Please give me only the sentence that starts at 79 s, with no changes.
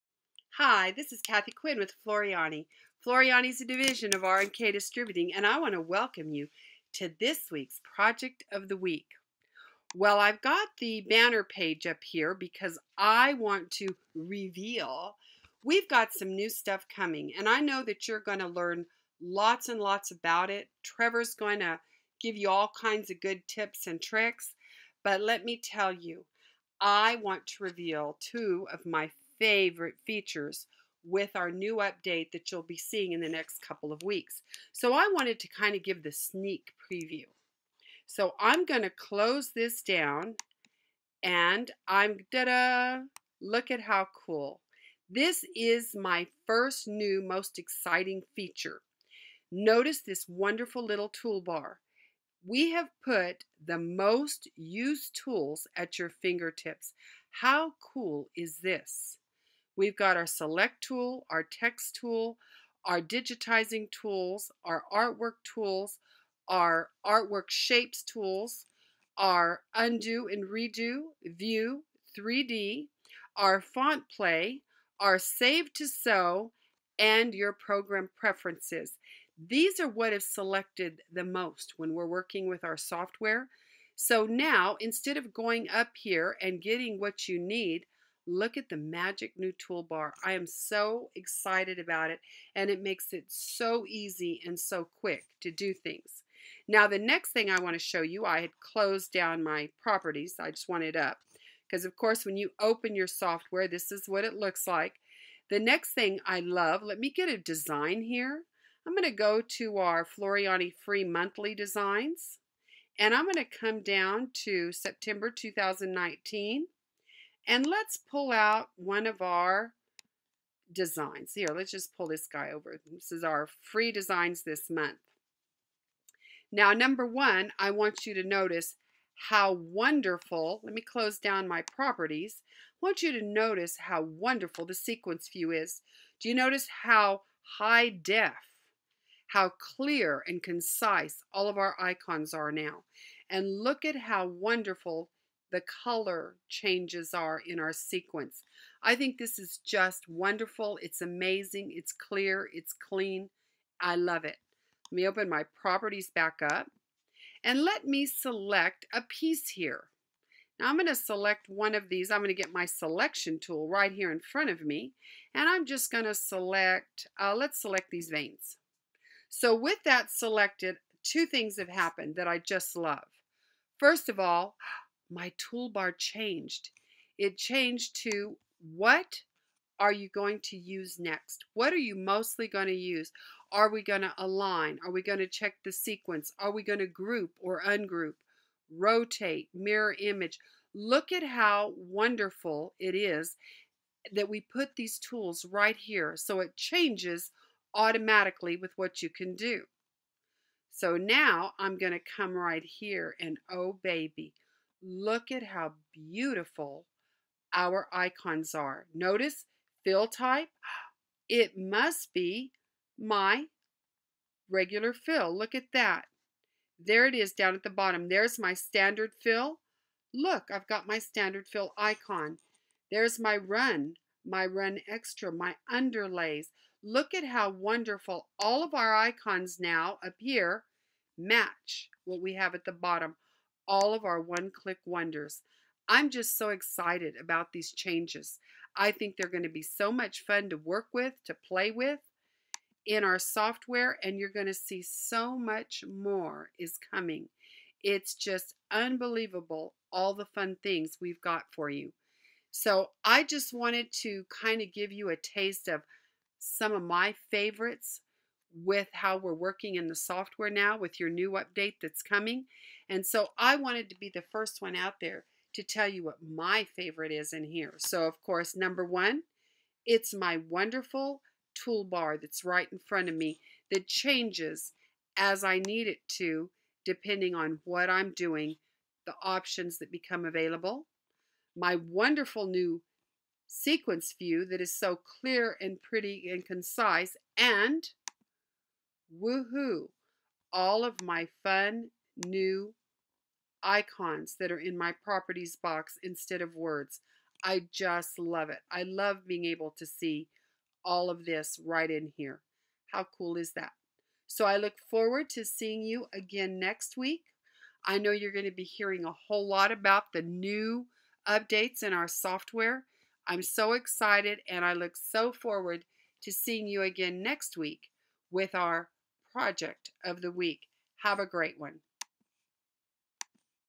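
These are what is selected the most when we're working with our software.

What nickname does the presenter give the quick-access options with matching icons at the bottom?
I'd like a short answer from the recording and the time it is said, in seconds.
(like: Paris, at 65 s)
one click wonders, at 234 s.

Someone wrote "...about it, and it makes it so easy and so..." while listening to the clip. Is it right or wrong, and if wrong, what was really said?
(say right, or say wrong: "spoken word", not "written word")
right.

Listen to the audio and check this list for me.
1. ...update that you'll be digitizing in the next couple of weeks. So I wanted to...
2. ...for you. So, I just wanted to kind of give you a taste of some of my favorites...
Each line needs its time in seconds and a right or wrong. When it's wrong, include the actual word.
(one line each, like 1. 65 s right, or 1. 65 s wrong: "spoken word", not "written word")
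1. 31 s wrong: "seeing", not "digitizing"
2. 251 s right.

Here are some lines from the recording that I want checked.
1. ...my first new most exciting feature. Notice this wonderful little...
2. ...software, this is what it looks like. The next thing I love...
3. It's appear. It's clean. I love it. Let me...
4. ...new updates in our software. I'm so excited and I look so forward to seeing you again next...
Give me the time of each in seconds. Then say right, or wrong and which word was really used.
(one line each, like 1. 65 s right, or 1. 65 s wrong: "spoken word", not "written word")
1. 45 s right
2. 103 s right
3. 151 s wrong: "clear", not "appear"
4. 310 s right.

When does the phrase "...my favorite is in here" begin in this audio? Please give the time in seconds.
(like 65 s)
266 s.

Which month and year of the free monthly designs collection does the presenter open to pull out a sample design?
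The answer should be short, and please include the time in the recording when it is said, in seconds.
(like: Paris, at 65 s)
September 2019, at 114 s.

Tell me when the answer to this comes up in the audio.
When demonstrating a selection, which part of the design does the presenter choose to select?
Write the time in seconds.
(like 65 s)
168 s.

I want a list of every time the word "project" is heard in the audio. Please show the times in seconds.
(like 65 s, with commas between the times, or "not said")
7 s, 319 s.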